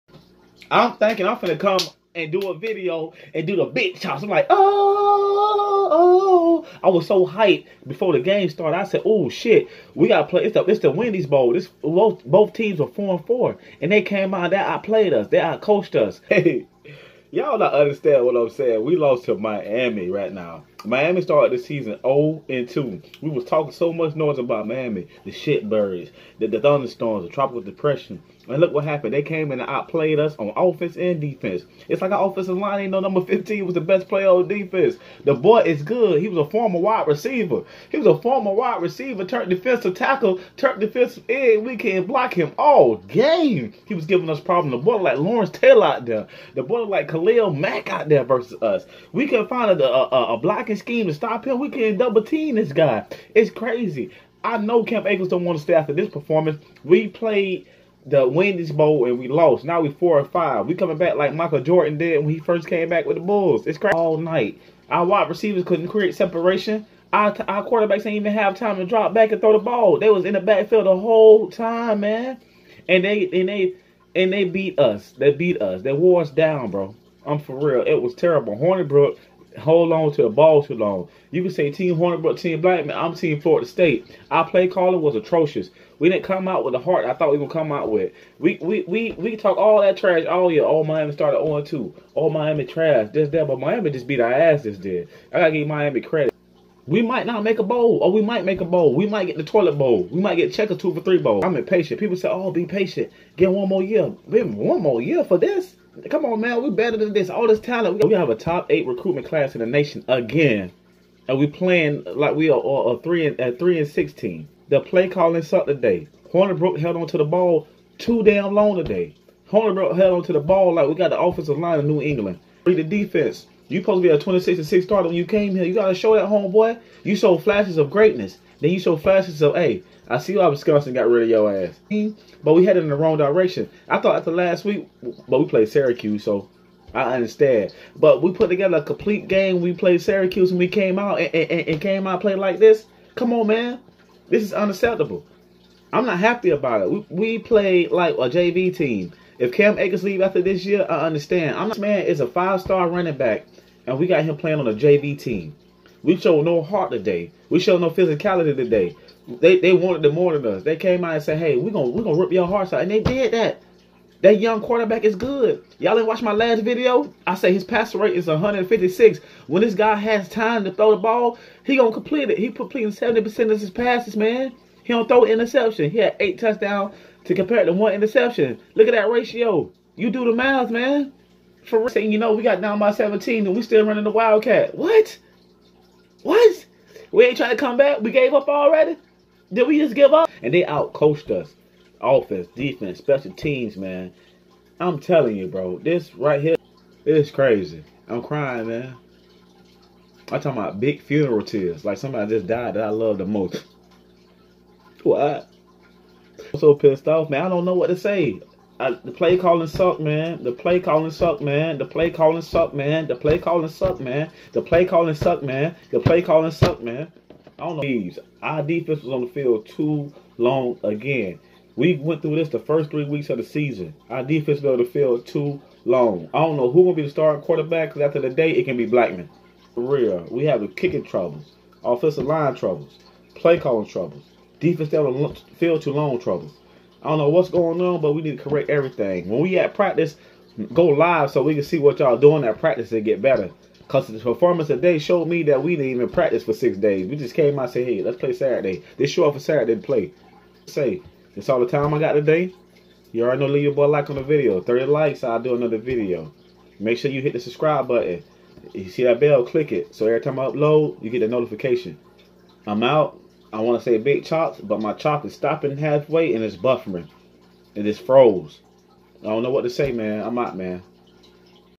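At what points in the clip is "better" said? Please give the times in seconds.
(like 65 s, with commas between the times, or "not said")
106 s, 243 s.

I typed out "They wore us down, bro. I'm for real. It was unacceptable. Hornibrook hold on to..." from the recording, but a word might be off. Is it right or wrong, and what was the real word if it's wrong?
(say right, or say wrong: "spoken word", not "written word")
wrong: "terrible", not "unacceptable".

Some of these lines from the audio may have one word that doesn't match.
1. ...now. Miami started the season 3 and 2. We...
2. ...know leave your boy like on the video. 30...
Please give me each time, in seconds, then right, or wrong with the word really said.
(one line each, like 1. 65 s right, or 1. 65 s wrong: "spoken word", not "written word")
1. 20 s wrong: "0", not "3"
2. 253 s right.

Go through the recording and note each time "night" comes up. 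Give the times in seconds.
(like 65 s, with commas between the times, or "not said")
64 s.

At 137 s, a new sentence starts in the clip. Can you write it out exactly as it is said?
But we put together a complete game.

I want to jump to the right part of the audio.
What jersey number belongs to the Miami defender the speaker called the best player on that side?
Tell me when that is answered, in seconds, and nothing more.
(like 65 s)
32 s.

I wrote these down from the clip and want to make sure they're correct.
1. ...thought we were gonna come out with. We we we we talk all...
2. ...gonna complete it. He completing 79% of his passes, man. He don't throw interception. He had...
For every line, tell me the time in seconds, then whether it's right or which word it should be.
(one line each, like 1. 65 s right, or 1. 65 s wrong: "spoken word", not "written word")
1. 87 s right
2. 171 s wrong: "70", not "79".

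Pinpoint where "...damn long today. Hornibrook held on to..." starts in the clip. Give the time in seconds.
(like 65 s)
118 s.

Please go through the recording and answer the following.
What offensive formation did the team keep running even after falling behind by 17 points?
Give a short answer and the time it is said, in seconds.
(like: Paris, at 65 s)
Wildcat, at 184 s.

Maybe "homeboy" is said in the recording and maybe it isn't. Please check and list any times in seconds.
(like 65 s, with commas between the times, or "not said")
126 s.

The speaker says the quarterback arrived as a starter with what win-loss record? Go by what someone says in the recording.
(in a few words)
26 and 6.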